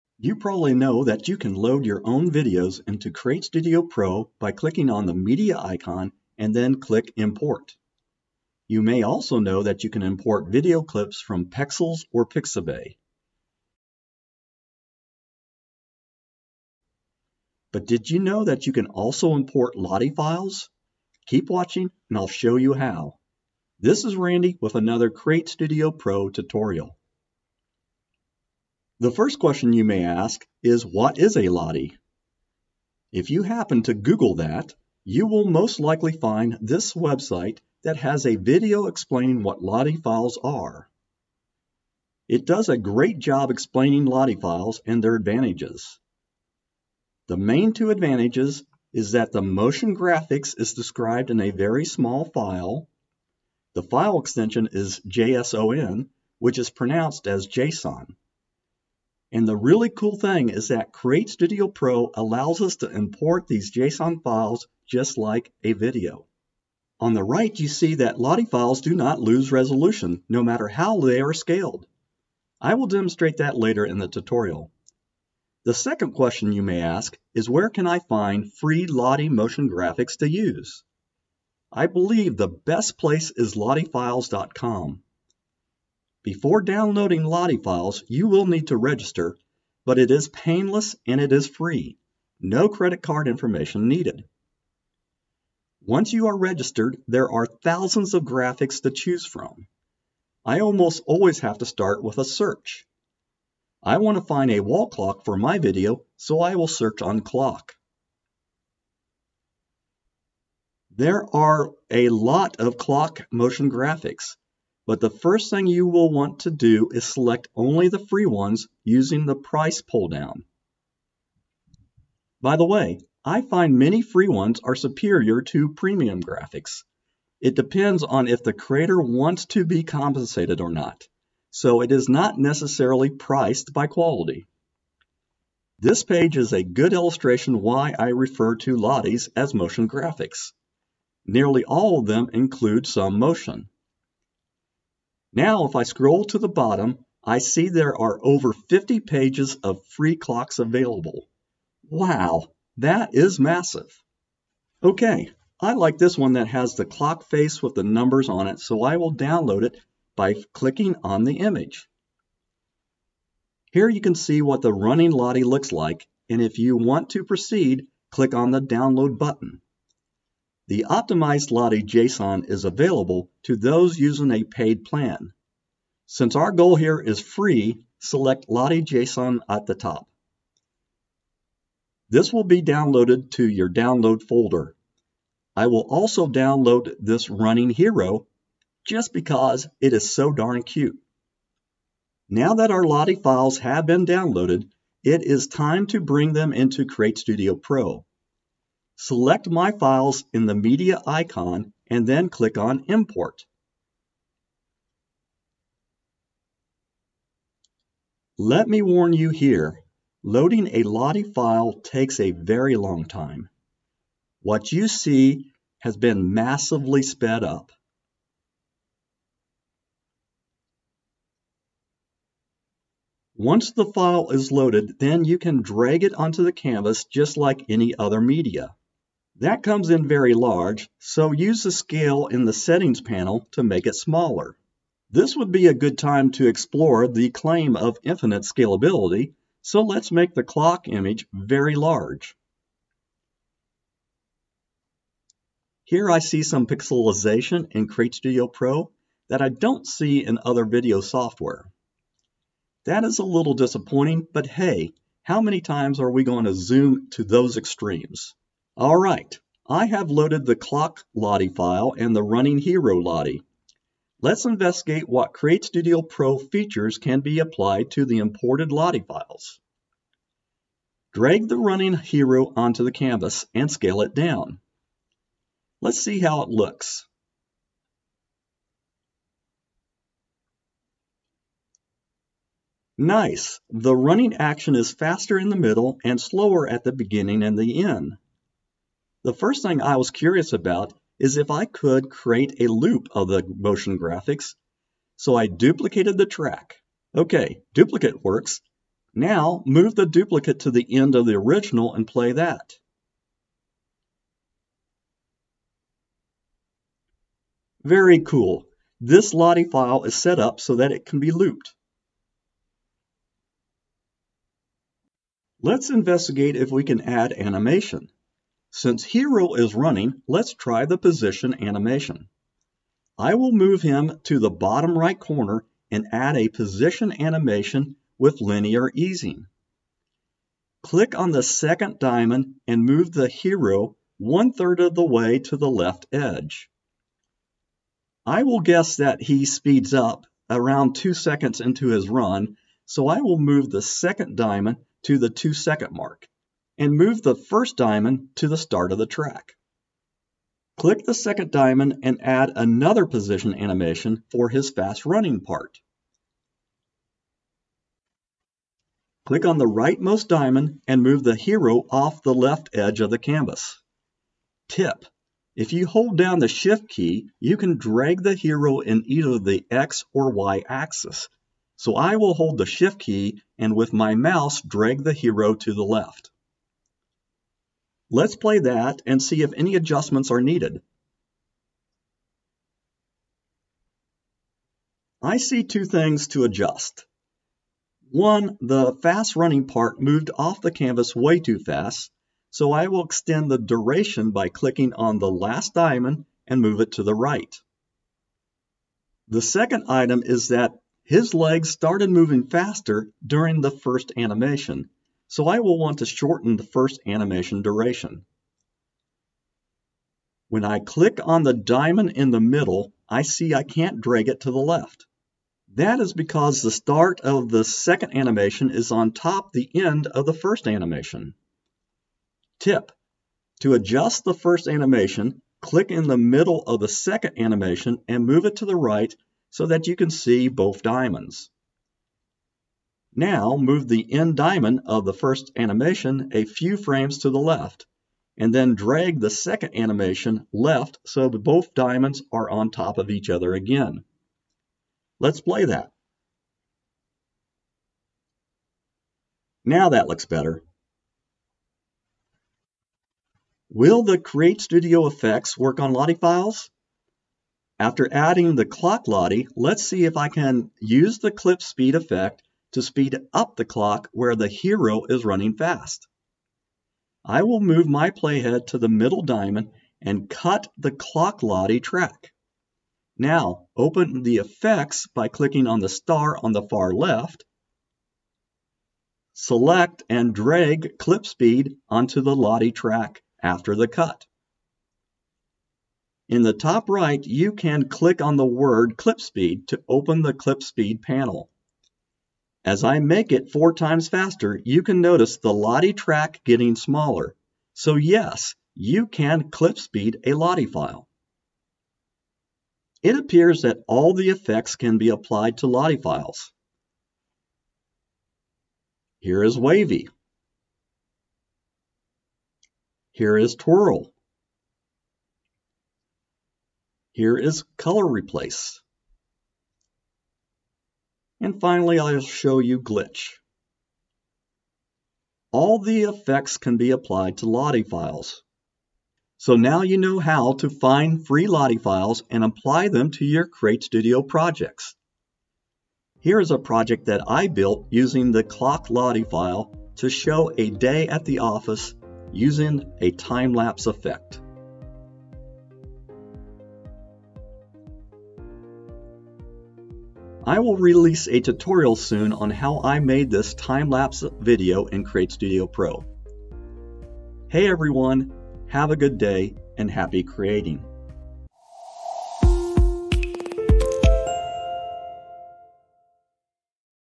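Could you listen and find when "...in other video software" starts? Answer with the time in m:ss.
4:10.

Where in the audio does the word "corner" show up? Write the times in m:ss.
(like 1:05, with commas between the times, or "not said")
5:25.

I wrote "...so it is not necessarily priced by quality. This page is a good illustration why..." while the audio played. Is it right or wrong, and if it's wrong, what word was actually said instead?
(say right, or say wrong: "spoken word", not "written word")
right.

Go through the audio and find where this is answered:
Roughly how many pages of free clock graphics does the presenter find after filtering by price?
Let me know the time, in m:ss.
2:28.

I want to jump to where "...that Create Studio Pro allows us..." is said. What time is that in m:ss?
1:00.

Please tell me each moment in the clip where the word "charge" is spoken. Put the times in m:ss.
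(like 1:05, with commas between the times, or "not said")
not said.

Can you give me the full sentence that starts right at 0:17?
But did you know that you can also import Lottie files?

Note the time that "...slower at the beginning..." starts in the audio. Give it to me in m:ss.
4:46.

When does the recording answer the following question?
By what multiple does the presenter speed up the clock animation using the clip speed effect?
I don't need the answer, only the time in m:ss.
8:13.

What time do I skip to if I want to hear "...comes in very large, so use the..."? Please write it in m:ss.
3:49.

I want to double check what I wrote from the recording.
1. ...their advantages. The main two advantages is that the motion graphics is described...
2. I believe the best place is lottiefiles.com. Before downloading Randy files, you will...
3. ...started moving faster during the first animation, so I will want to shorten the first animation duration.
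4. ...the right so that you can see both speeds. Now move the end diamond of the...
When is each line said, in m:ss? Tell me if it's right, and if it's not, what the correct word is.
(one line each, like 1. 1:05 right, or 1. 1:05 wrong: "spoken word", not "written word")
1. 0:45 right
2. 1:21 wrong: "Lottie", not "Randy"
3. 6:41 right
4. 7:08 wrong: "diamonds", not "speeds".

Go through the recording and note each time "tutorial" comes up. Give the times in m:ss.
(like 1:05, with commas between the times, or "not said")
0:26, 1:14, 9:11.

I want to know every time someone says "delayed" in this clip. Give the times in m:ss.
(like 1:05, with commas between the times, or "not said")
not said.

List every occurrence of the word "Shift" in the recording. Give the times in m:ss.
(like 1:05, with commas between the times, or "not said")
6:06, 6:12.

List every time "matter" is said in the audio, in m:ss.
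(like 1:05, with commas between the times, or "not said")
1:10.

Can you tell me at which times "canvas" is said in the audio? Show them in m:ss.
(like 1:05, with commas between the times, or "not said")
3:46, 4:32, 6:03, 6:30.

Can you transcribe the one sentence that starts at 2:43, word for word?
Here you can see what the running Lottie looks like, and if you want to proceed, click on the download button.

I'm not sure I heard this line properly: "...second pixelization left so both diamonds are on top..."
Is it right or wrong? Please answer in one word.
wrong.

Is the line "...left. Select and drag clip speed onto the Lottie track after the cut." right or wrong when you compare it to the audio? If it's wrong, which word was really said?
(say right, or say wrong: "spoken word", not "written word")
right.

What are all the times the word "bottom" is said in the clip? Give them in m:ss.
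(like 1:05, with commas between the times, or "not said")
2:26, 5:24.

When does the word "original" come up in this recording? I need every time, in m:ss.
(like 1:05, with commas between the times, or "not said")
5:01.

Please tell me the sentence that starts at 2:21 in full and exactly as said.
Nearly all of them include some motion.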